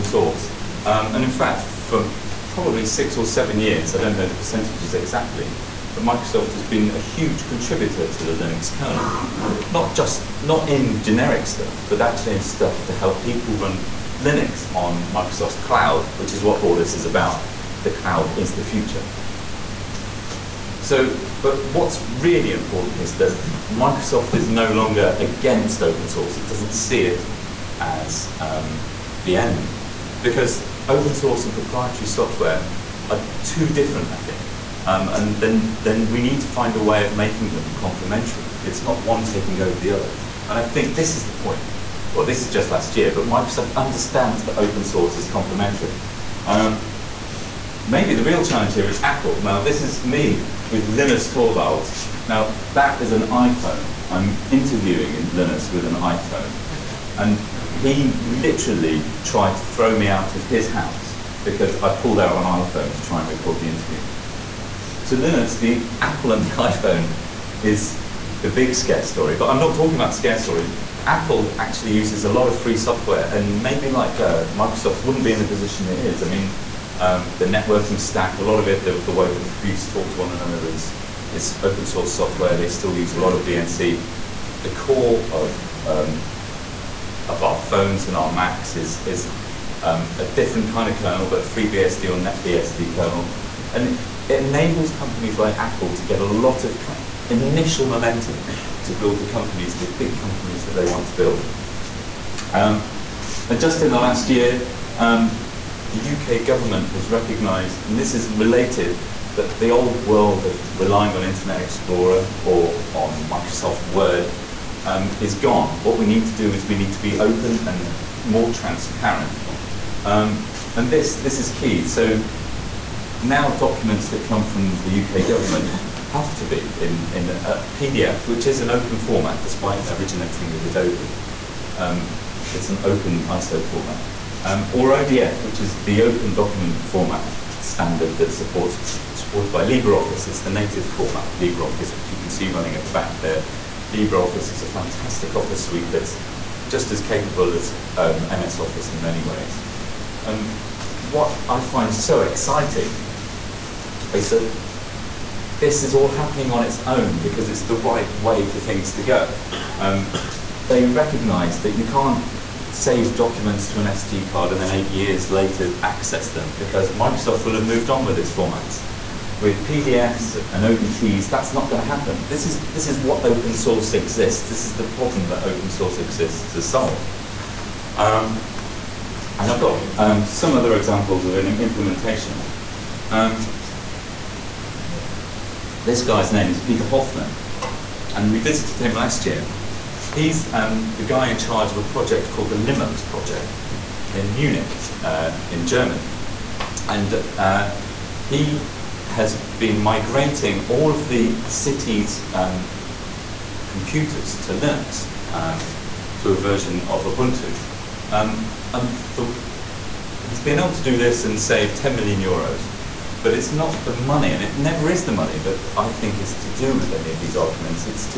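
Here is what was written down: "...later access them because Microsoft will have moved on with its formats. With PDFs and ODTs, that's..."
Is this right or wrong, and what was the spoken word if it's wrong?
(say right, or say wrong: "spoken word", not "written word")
right.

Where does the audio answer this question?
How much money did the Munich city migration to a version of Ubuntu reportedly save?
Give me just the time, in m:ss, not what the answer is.
3:31.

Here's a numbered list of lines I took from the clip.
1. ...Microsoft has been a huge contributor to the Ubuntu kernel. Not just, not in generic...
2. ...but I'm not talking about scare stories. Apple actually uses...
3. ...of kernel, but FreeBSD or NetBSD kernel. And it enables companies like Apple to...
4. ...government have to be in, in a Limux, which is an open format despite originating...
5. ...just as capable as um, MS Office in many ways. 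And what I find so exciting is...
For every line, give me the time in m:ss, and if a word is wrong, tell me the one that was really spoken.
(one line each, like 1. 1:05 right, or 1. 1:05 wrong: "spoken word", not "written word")
1. 0:06 wrong: "Linux", not "Ubuntu"
2. 1:09 right
3. 1:30 right
4. 2:05 wrong: "PDF", not "Limux"
5. 2:26 right.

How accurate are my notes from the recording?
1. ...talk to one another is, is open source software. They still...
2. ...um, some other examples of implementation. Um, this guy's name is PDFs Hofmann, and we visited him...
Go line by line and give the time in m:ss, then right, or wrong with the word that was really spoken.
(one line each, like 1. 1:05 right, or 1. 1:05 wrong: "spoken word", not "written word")
1. 1:19 right
2. 2:59 wrong: "Peter", not "PDFs".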